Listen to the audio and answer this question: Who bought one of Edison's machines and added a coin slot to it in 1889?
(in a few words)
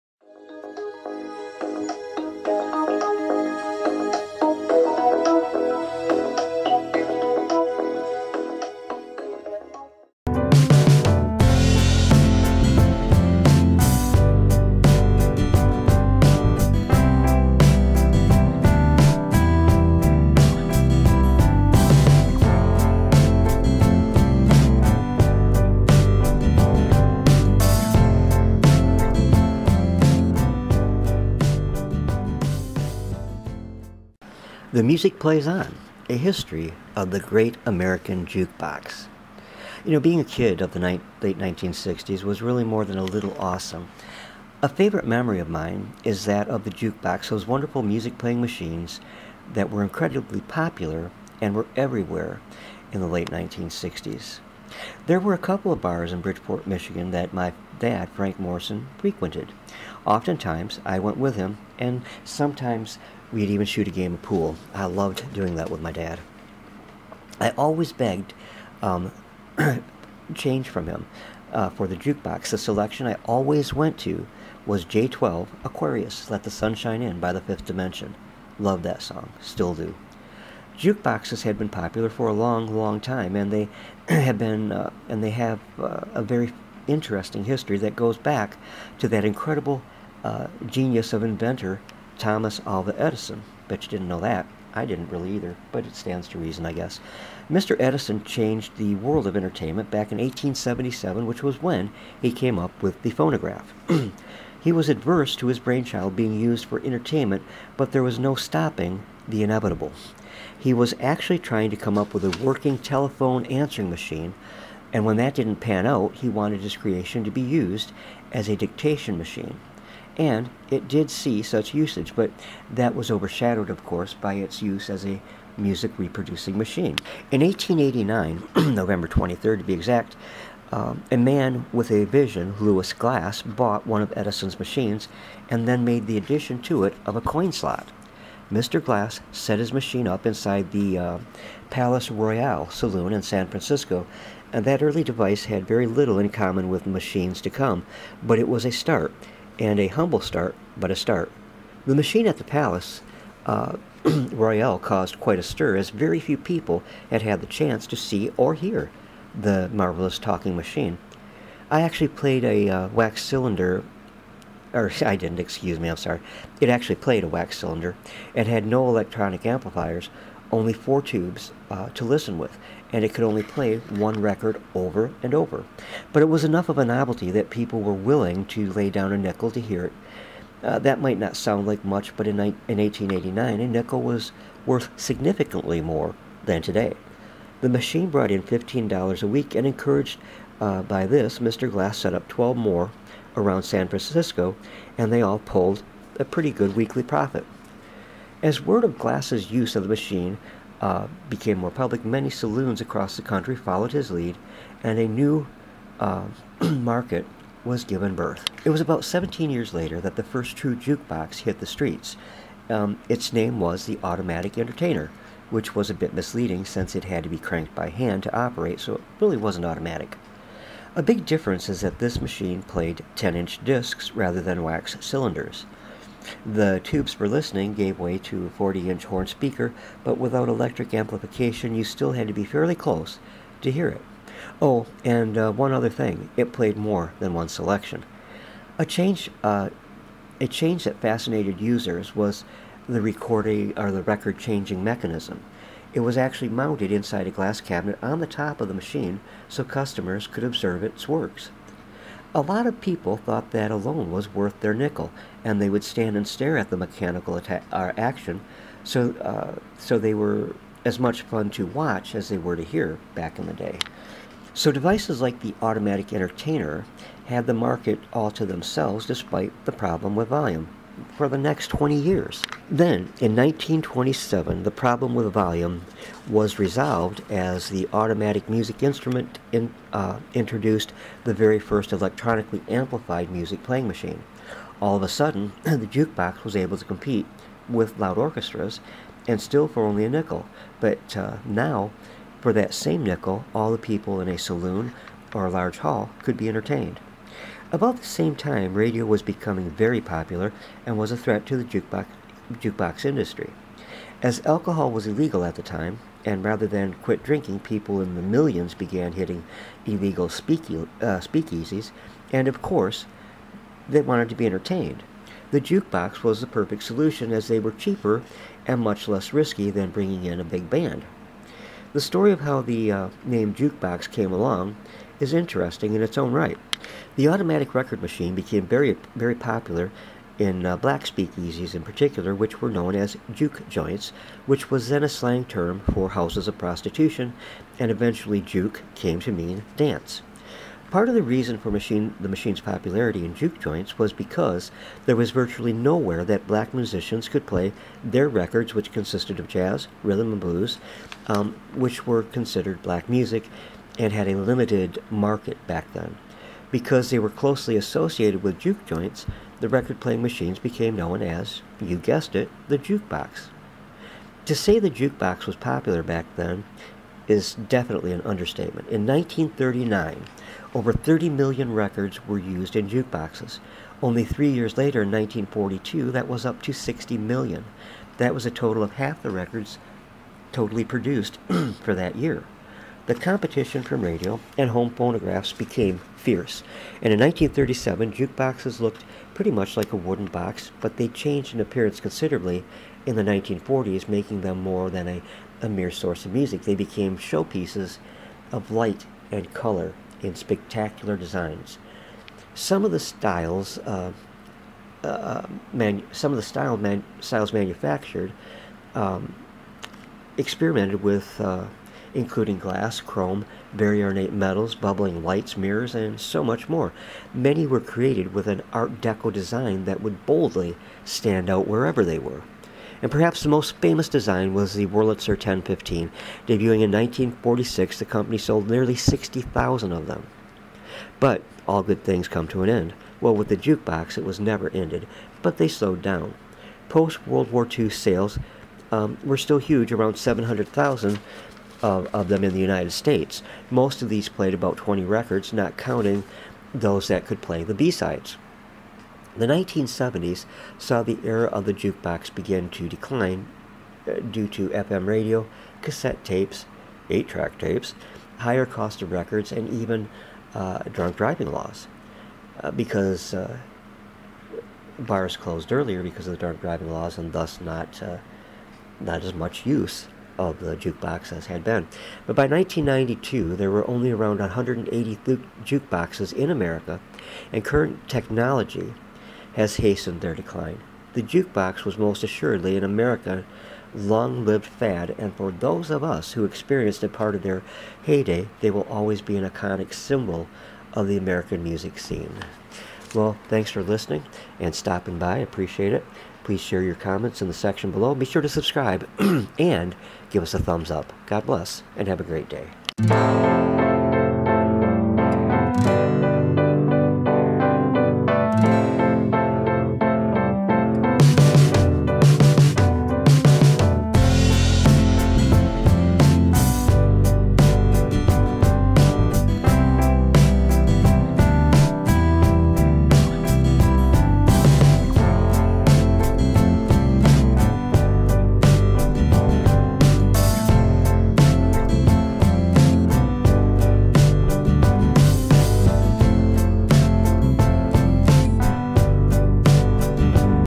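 Lewis Glass.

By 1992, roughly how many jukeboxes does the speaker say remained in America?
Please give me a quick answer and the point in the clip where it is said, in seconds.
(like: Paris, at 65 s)
180, at 474 s.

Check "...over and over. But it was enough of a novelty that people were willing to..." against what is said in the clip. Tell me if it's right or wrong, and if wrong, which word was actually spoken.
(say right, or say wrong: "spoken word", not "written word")
right.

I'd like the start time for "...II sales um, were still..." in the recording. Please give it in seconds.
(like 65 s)
437 s.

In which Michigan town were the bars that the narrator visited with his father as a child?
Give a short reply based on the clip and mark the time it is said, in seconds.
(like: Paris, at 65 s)
Bridgeport, at 56 s.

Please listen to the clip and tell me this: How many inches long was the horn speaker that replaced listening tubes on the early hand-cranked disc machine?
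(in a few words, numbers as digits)
40 inches.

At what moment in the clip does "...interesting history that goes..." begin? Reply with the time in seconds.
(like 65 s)
86 s.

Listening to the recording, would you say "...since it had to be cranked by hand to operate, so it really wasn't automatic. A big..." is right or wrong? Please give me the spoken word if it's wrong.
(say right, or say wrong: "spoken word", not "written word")
right.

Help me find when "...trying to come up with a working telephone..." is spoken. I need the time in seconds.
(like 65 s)
111 s.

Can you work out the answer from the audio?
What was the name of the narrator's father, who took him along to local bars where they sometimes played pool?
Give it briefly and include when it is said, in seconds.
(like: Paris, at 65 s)
Frank Morrison, at 58 s.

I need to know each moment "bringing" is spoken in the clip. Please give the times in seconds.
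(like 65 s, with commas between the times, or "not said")
319 s.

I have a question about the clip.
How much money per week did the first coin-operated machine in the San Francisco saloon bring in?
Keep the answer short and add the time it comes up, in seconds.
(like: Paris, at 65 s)
$15, at 188 s.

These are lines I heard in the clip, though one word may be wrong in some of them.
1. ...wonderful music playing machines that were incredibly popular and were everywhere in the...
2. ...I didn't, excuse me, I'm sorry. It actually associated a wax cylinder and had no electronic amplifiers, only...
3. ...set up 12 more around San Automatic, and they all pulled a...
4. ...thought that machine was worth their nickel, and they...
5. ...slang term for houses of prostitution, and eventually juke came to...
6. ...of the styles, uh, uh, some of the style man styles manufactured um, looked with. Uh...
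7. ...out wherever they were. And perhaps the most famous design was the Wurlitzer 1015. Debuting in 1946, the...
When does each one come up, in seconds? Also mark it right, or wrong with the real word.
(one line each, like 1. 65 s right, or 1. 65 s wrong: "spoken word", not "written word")
1. 47 s right
2. 165 s wrong: "played", not "associated"
3. 191 s wrong: "Francisco", not "Automatic"
4. 253 s wrong: "alone", not "machine"
5. 335 s right
6. 402 s wrong: "experimented", not "looked"
7. 421 s right.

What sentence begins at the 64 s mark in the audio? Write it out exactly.
I loved doing that with my dad.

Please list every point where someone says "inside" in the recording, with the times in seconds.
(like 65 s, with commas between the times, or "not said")
140 s, 246 s.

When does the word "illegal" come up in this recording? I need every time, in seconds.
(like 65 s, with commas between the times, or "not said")
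305 s, 309 s.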